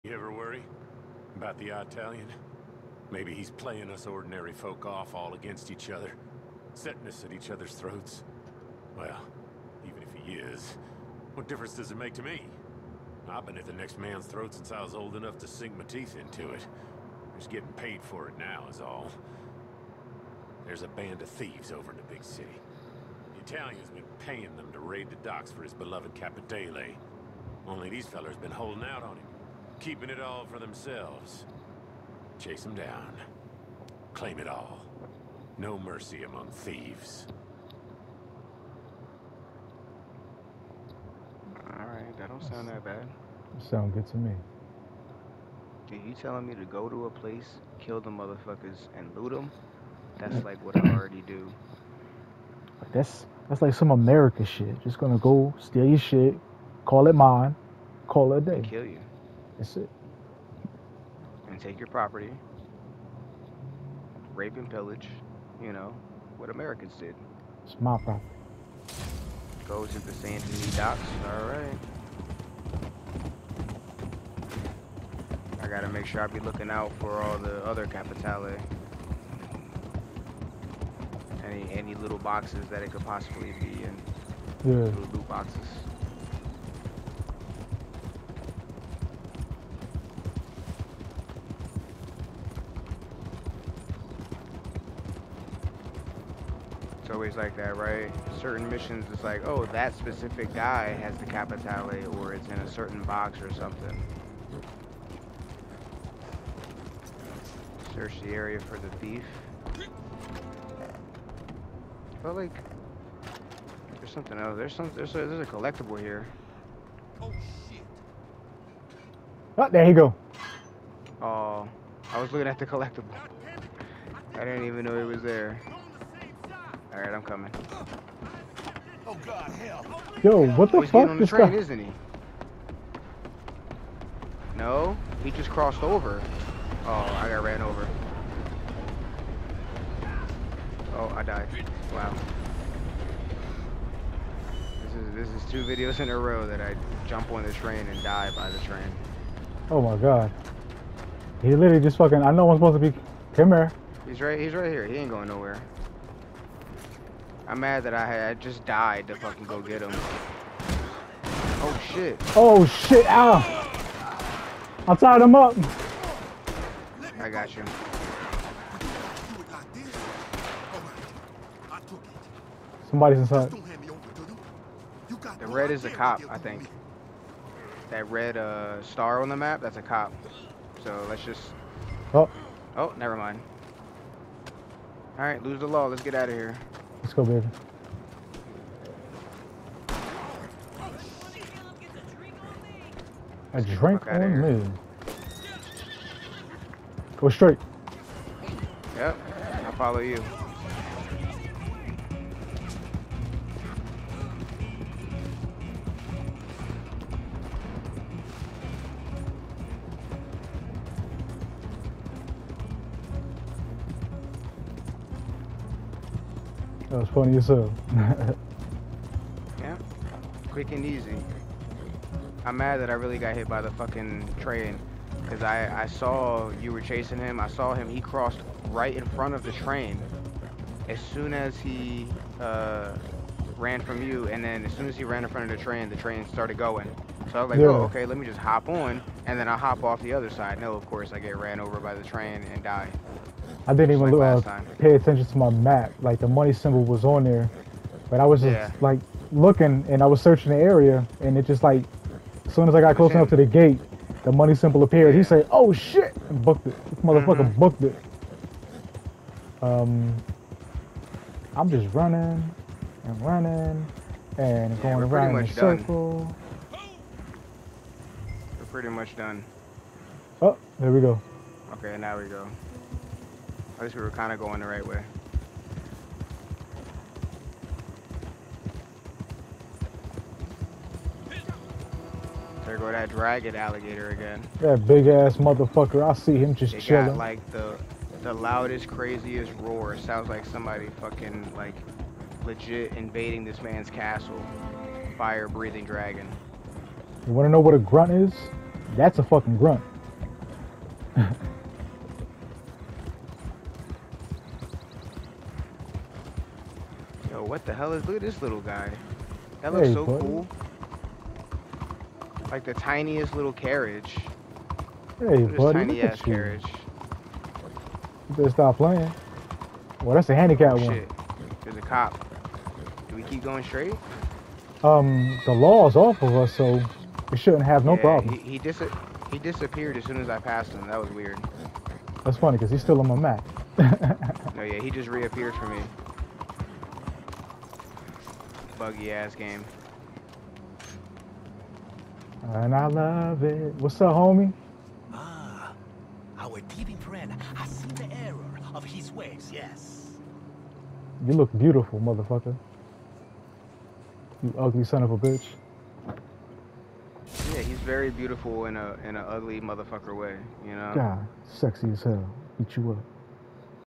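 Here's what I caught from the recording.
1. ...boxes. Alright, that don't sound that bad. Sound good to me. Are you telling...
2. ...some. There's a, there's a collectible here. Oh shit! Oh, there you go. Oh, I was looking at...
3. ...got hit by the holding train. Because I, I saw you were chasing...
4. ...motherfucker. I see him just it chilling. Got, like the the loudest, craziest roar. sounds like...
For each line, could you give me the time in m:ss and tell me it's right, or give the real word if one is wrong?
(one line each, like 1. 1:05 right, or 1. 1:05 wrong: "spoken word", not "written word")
1. 0:36 wrong: "thieves", not "boxes"
2. 1:54 right
3. 3:43 wrong: "fucking", not "holding"
4. 4:45 right.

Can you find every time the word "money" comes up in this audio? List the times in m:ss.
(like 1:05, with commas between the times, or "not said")
4:06, 4:14.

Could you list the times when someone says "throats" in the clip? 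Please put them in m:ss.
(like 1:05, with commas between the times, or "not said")
0:07, 0:14.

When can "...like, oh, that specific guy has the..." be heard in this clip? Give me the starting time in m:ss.
1:39.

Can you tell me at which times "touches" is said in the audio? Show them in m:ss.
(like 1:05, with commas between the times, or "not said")
not said.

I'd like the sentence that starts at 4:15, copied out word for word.
He said, "Oh shit!" and booked it.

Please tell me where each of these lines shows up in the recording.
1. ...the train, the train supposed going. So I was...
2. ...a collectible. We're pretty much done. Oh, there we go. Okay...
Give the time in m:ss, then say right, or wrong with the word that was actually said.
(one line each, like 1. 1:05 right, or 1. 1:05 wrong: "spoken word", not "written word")
1. 3:55 wrong: "started", not "supposed"
2. 4:25 wrong: "circle", not "collectible".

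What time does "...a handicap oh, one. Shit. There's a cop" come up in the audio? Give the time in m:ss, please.
5:20.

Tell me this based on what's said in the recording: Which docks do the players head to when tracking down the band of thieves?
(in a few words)
San Antonio docks.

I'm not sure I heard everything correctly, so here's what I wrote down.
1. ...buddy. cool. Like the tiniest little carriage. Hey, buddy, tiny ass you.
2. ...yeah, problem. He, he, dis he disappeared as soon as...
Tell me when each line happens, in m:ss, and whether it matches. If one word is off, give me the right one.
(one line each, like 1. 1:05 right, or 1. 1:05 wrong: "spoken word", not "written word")
1. 5:10 right
2. 5:27 right.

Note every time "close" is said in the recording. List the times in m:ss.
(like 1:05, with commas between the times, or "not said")
4:12.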